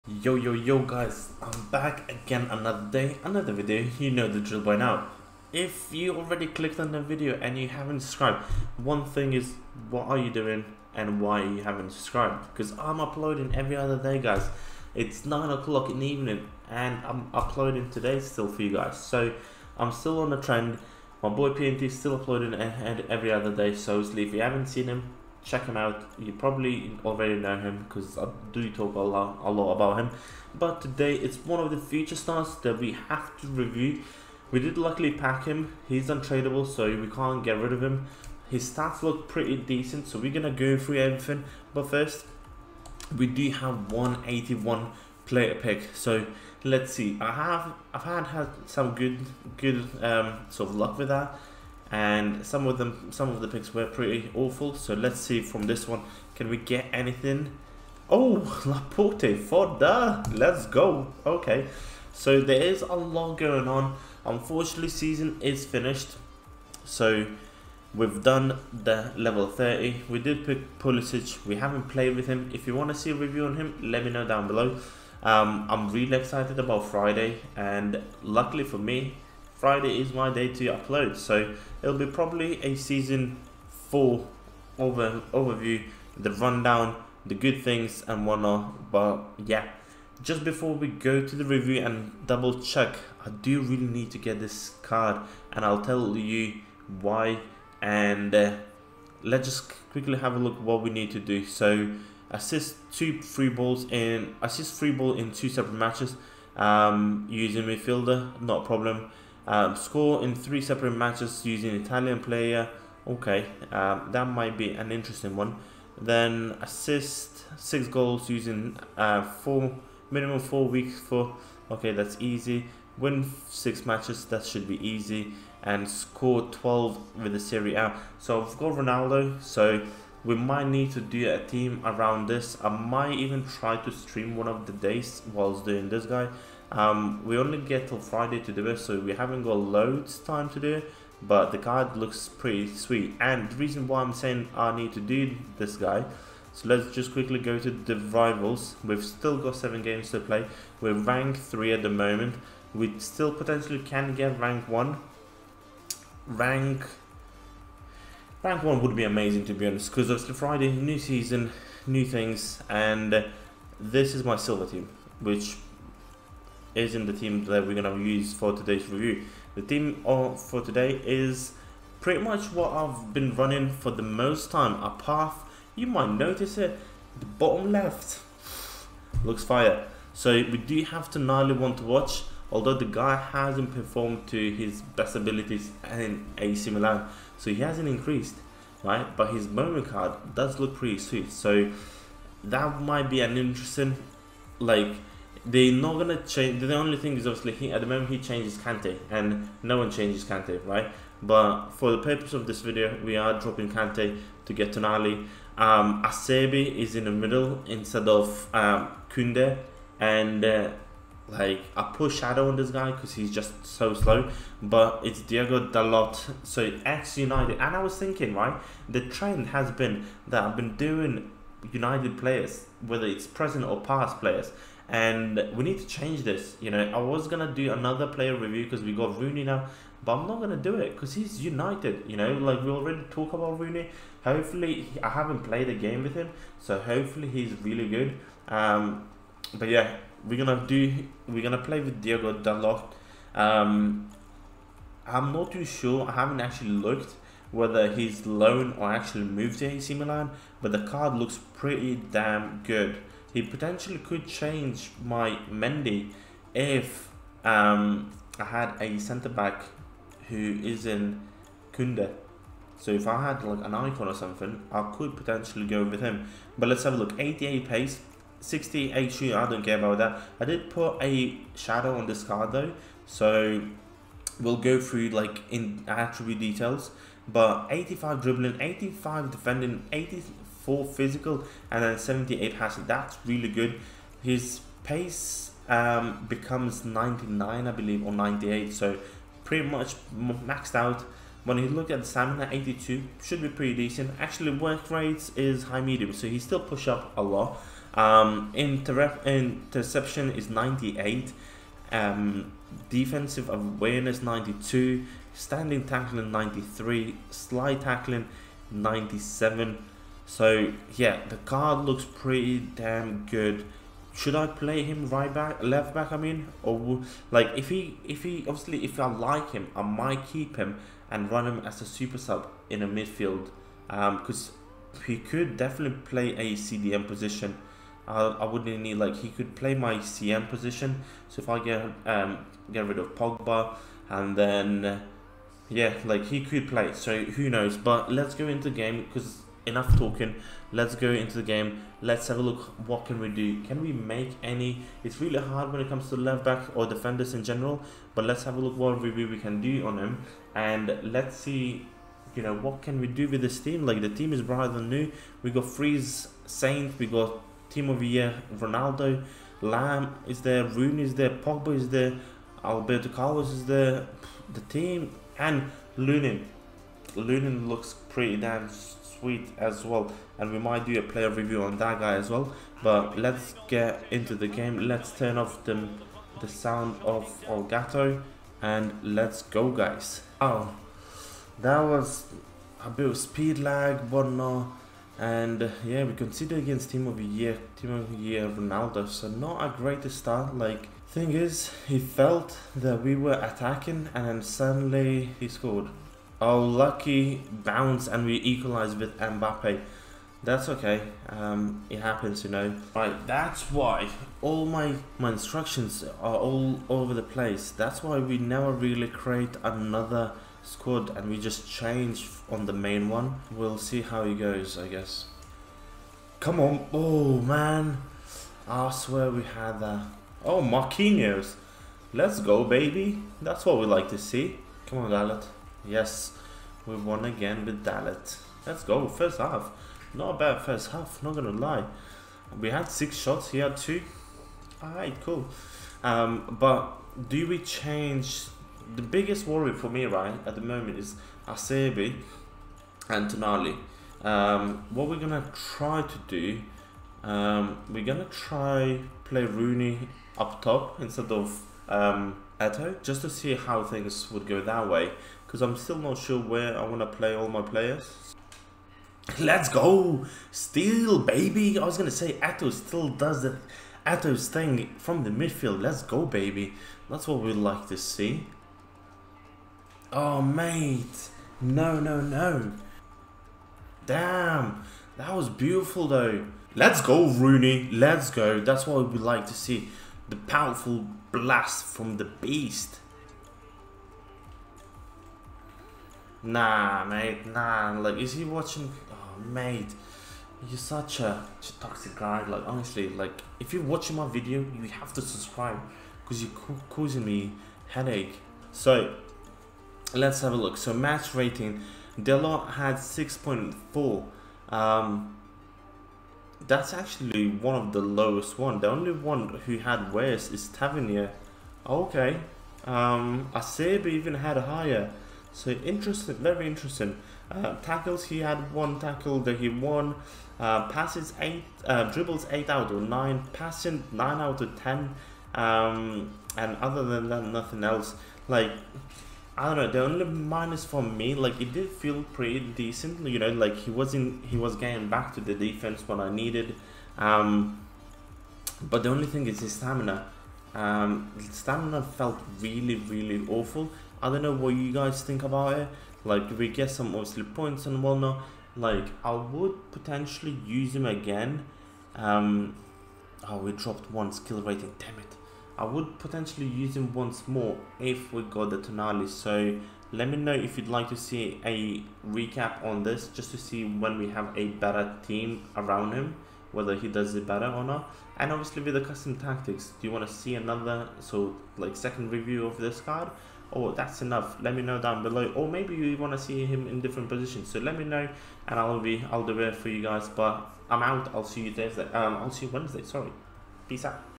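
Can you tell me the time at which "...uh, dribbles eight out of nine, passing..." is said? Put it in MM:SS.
08:41.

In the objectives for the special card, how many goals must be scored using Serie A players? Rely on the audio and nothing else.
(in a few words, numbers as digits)
12.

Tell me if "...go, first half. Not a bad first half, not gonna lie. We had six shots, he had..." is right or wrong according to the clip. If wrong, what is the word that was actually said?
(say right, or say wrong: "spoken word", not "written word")
right.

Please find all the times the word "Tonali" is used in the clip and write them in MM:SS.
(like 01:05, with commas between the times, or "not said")
03:24, 07:23, 09:18.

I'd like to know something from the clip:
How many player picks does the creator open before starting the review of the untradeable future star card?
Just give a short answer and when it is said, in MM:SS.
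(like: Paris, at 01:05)
181, at 00:43.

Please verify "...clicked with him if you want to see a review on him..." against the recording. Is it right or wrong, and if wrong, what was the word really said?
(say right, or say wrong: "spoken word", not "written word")
wrong: "played", not "clicked".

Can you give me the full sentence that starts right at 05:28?
I, I wouldn't need like he could play my CM position.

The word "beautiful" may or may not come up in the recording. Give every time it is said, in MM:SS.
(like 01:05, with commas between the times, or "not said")
07:55.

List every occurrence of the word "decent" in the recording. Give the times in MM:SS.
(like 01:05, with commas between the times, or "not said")
00:39, 04:53, 08:52.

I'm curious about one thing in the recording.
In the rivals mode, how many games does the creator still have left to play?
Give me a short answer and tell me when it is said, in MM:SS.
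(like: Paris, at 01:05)
7, at 02:29.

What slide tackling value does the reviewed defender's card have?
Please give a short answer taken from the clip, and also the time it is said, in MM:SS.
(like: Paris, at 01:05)
97, at 05:08.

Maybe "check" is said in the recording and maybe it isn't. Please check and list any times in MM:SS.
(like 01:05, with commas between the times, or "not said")
00:25, 01:32.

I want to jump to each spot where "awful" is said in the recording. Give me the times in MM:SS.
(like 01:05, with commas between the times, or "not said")
00:54, 09:03.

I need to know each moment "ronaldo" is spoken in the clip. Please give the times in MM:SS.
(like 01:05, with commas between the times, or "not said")
02:08, 05:58, 06:28.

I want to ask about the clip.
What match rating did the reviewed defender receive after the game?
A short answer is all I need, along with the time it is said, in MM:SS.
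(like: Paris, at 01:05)
6.4, at 08:22.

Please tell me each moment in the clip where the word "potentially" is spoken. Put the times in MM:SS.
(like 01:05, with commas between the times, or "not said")
02:33, 04:13, 04:25, 09:09, 09:16.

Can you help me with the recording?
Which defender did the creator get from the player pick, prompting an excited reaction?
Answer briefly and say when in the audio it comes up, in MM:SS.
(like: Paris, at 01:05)
Laporte, at 00:58.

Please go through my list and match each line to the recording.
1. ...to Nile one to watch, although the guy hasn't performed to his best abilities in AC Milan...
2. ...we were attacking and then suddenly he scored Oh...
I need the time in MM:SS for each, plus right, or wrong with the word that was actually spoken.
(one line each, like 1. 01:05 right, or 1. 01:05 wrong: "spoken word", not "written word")
1. 03:01 right
2. 06:33 right.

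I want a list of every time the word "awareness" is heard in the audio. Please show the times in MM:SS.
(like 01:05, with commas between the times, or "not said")
05:03.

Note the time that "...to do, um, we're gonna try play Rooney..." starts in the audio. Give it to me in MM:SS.
07:26.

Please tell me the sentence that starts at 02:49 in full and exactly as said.
The team for today is pretty much what I've been running for the most time.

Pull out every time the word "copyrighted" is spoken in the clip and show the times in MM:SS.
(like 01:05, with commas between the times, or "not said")
not said.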